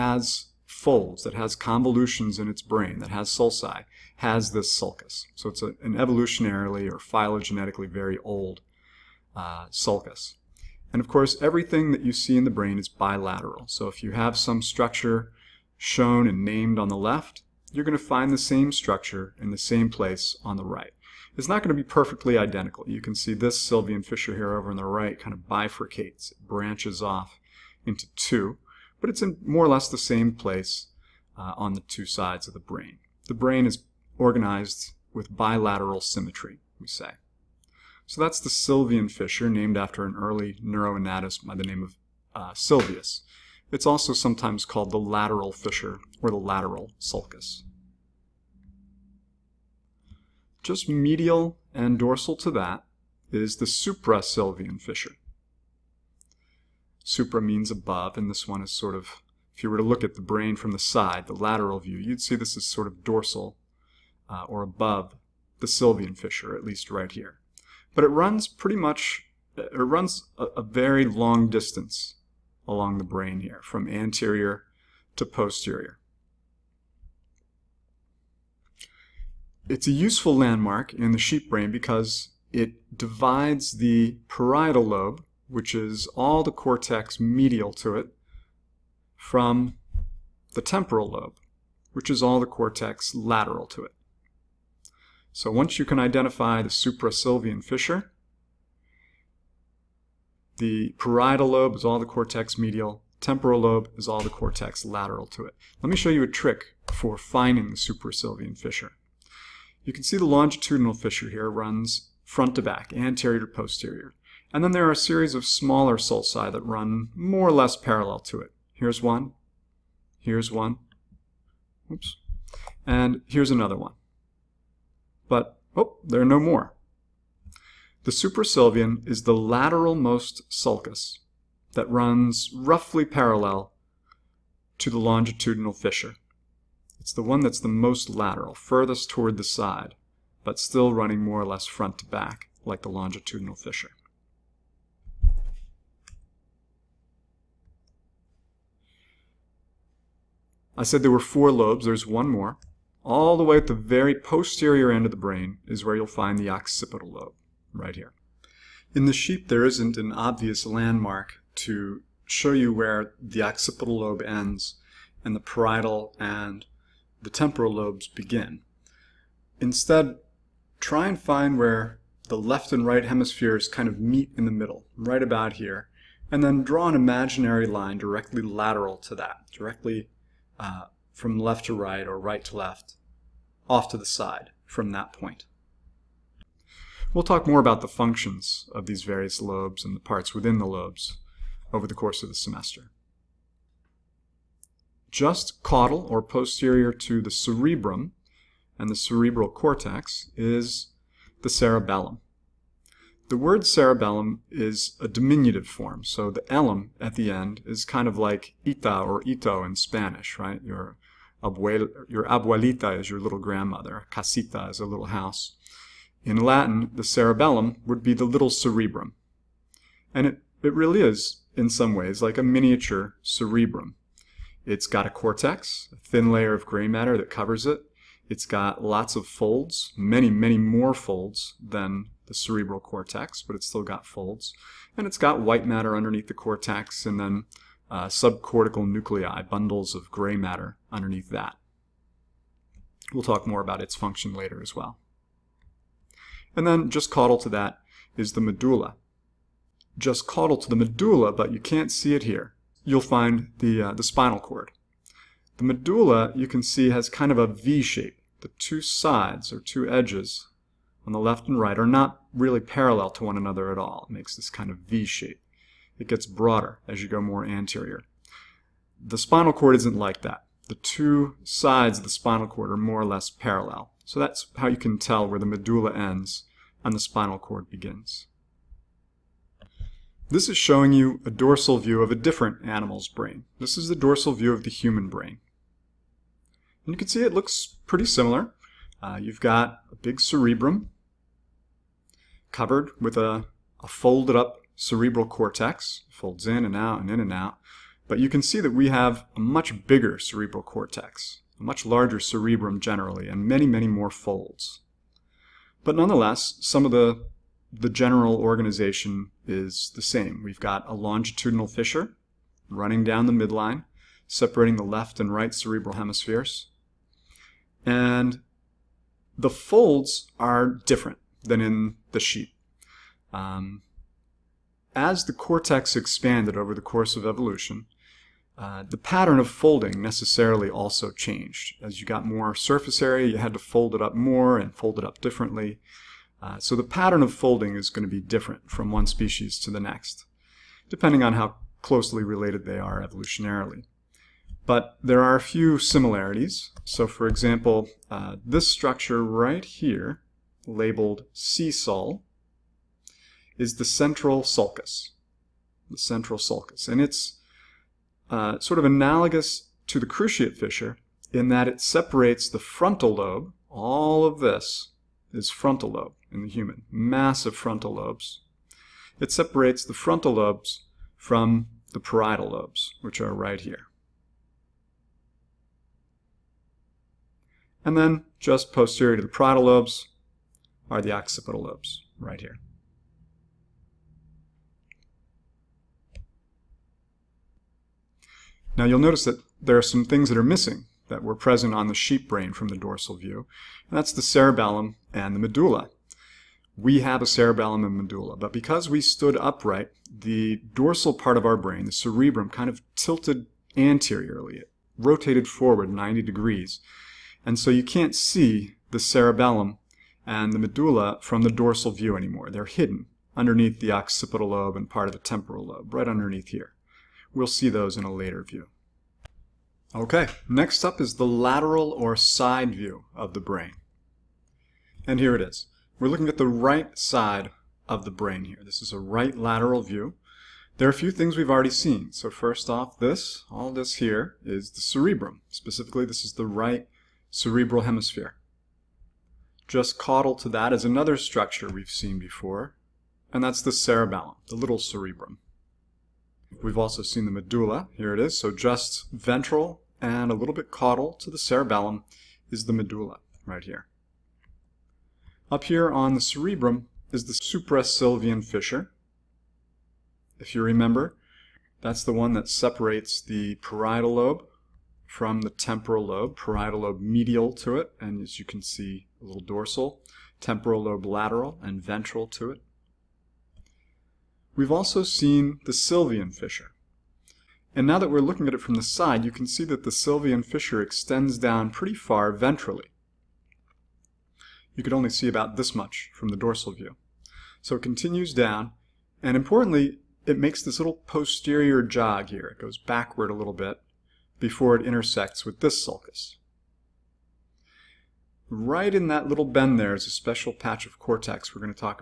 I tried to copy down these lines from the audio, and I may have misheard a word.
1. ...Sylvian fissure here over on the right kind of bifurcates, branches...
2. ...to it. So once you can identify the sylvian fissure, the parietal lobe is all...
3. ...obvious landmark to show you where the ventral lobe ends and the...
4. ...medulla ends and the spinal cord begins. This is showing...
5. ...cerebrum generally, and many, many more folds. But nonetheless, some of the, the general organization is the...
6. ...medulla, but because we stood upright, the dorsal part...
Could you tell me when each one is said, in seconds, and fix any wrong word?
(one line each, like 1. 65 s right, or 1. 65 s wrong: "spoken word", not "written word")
1. 23 s right
2. 93 s wrong: "suprasylvian", not "sylvian"
3. 160 s wrong: "occipital", not "ventral"
4. 275 s right
5. 302 s right
6. 397 s right.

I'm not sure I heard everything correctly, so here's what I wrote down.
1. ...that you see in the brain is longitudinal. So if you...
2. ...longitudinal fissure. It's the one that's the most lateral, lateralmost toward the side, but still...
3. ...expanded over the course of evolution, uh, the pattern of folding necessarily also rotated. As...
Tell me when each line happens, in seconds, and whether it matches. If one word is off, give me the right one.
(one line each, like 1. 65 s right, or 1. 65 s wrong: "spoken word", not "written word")
1. 11 s wrong: "bilateral", not "longitudinal"
2. 134 s wrong: "furthest", not "lateralmost"
3. 325 s wrong: "changed", not "rotated".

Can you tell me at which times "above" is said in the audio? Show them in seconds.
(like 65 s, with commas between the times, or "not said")
57 s, 64 s.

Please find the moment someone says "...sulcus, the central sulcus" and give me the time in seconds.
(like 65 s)
354 s.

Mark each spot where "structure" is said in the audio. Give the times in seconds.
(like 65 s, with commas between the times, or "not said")
14 s, 18 s, 348 s, 441 s.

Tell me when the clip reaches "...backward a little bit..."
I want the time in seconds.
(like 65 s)
492 s.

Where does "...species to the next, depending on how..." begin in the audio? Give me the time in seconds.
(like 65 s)
339 s.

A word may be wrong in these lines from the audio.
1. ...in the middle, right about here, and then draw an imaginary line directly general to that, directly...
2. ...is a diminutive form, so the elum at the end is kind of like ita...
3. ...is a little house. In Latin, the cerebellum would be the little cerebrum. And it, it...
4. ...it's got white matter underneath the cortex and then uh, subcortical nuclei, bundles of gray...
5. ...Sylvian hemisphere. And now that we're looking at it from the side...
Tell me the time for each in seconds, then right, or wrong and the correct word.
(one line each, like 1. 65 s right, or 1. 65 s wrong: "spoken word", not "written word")
1. 174 s wrong: "lateral", not "general"
2. 204 s right
3. 214 s right
4. 235 s right
5. 475 s wrong: "fissure", not "hemisphere".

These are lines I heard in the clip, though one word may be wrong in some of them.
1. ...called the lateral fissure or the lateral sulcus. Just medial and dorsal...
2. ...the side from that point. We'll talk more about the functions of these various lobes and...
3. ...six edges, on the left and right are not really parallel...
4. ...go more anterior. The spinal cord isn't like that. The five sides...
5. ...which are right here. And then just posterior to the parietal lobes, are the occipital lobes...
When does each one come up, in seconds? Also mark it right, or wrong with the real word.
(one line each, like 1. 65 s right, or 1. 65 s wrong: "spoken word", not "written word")
1. 44 s right
2. 183 s right
3. 259 s wrong: "two", not "six"
4. 267 s wrong: "two", not "five"
5. 373 s right.